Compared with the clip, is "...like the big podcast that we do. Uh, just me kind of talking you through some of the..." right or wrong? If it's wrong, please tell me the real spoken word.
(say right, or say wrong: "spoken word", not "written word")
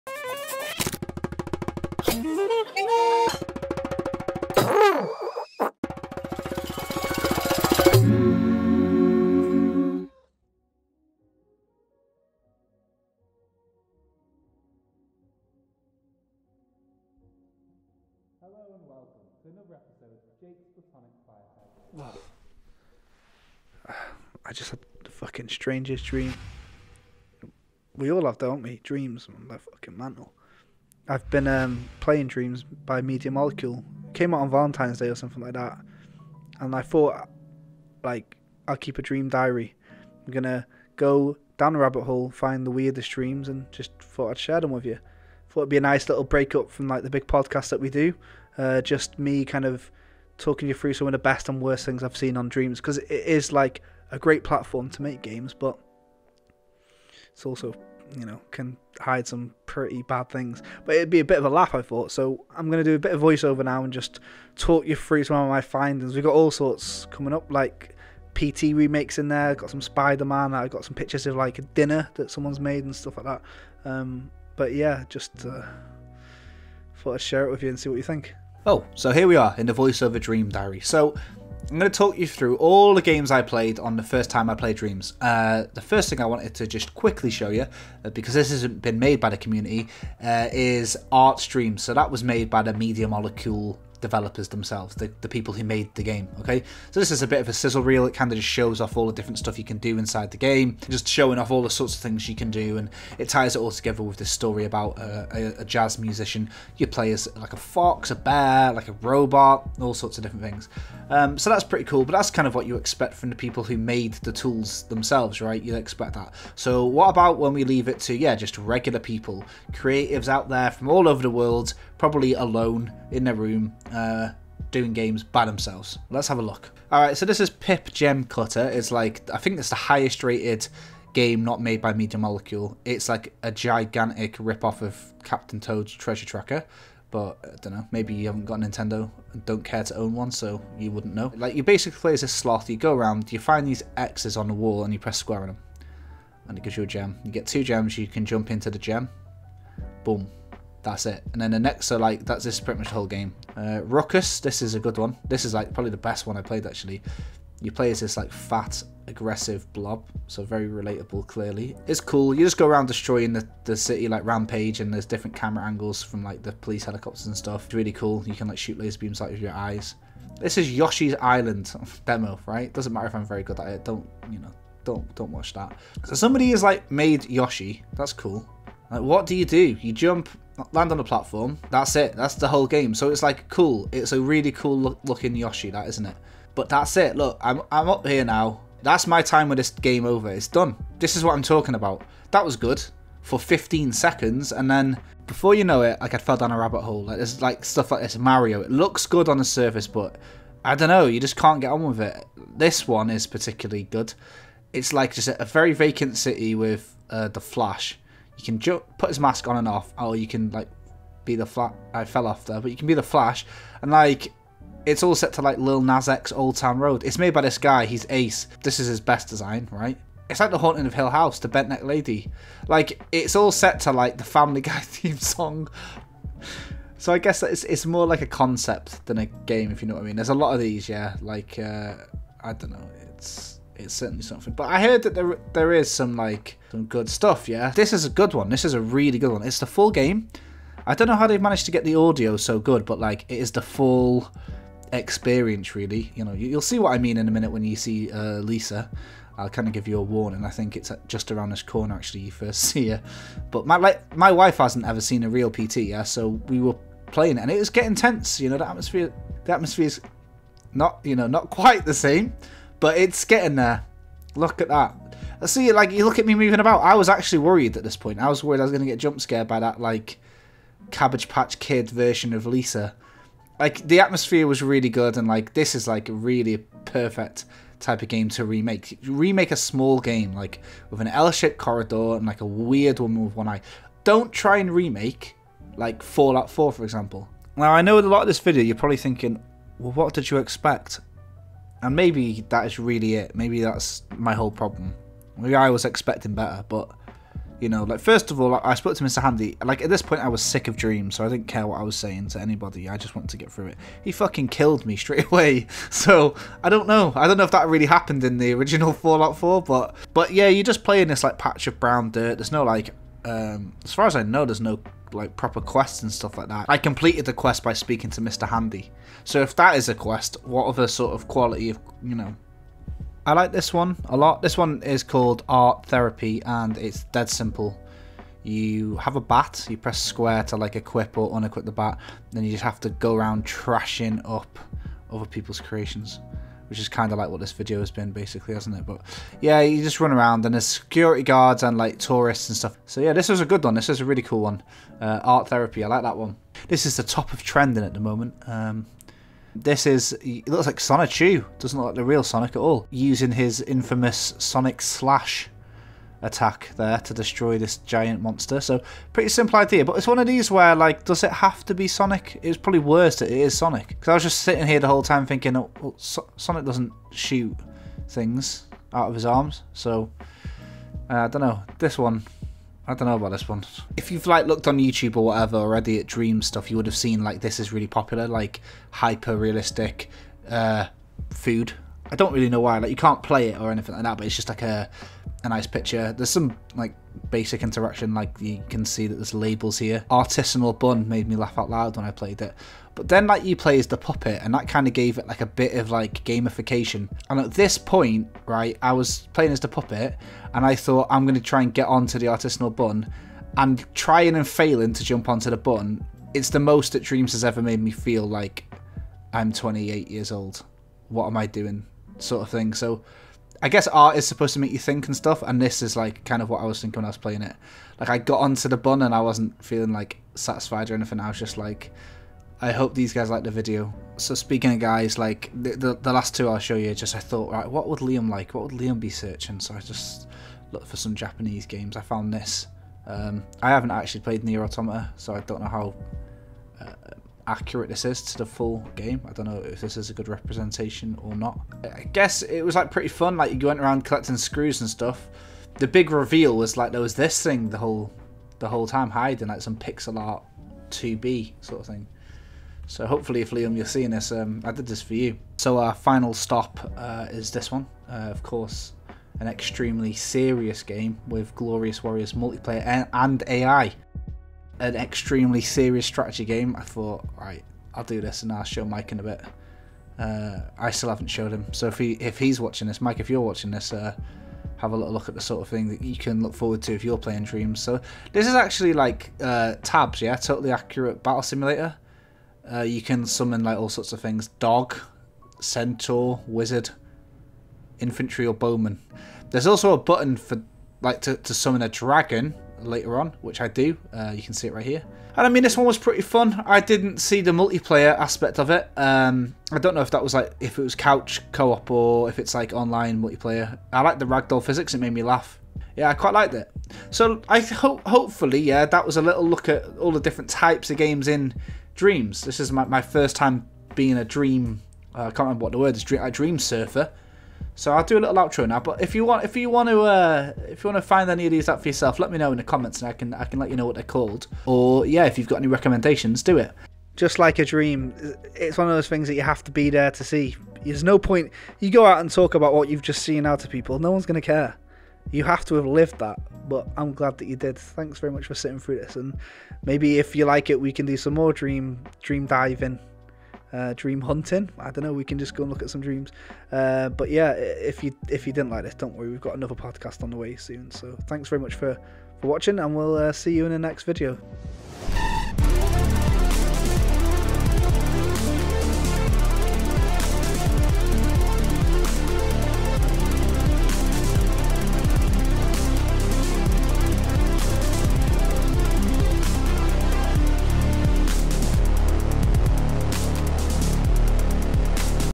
right.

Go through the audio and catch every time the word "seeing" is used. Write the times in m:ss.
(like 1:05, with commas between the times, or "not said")
7:33.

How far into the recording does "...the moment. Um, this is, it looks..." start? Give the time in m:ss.
5:47.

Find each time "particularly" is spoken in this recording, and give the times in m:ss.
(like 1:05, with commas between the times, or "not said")
3:23.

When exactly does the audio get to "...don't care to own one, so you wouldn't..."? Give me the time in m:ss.
2:19.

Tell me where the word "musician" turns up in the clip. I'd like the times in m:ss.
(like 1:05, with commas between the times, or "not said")
1:45.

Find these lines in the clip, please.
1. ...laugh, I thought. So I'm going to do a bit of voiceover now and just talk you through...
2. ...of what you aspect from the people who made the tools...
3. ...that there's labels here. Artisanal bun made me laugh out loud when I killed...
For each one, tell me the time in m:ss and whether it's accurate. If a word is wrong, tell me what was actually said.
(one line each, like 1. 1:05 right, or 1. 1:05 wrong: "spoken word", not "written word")
1. 1:01 right
2. 1:52 wrong: "expect", not "aspect"
3. 6:29 wrong: "played", not "killed".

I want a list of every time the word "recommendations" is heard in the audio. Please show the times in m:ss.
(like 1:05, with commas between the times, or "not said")
8:45.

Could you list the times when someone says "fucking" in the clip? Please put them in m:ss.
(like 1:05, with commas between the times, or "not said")
0:25, 0:29, 5:04.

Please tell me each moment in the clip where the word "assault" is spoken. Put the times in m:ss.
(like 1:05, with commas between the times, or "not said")
not said.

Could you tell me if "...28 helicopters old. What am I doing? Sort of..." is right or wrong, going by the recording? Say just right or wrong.
wrong.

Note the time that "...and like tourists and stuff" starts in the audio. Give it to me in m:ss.
5:41.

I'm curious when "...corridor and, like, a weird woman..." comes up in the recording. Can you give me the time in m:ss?
4:41.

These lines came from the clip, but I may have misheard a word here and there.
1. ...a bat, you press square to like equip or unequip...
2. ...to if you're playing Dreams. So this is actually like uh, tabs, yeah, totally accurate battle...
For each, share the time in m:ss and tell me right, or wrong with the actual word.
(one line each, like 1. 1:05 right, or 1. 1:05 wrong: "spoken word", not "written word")
1. 5:29 right
2. 7:56 right.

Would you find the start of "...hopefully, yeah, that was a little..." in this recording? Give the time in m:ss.
8:28.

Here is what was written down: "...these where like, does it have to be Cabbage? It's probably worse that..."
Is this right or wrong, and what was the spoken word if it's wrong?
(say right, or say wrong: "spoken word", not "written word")
wrong: "Sonic", not "Cabbage".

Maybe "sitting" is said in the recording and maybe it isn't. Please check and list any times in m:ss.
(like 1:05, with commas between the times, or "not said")
6:04, 8:58.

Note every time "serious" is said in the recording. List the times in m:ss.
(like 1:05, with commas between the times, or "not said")
7:40, 7:45.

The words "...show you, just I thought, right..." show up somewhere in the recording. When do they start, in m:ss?
7:06.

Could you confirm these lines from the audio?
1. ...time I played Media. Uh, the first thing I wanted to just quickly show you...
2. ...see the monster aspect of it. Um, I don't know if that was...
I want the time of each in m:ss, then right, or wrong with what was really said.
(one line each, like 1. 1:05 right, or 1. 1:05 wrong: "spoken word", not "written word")
1. 1:24 wrong: "Dreams", not "Media"
2. 8:17 wrong: "multiplayer", not "monster".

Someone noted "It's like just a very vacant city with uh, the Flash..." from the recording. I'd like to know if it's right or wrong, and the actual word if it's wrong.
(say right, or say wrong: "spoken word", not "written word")
right.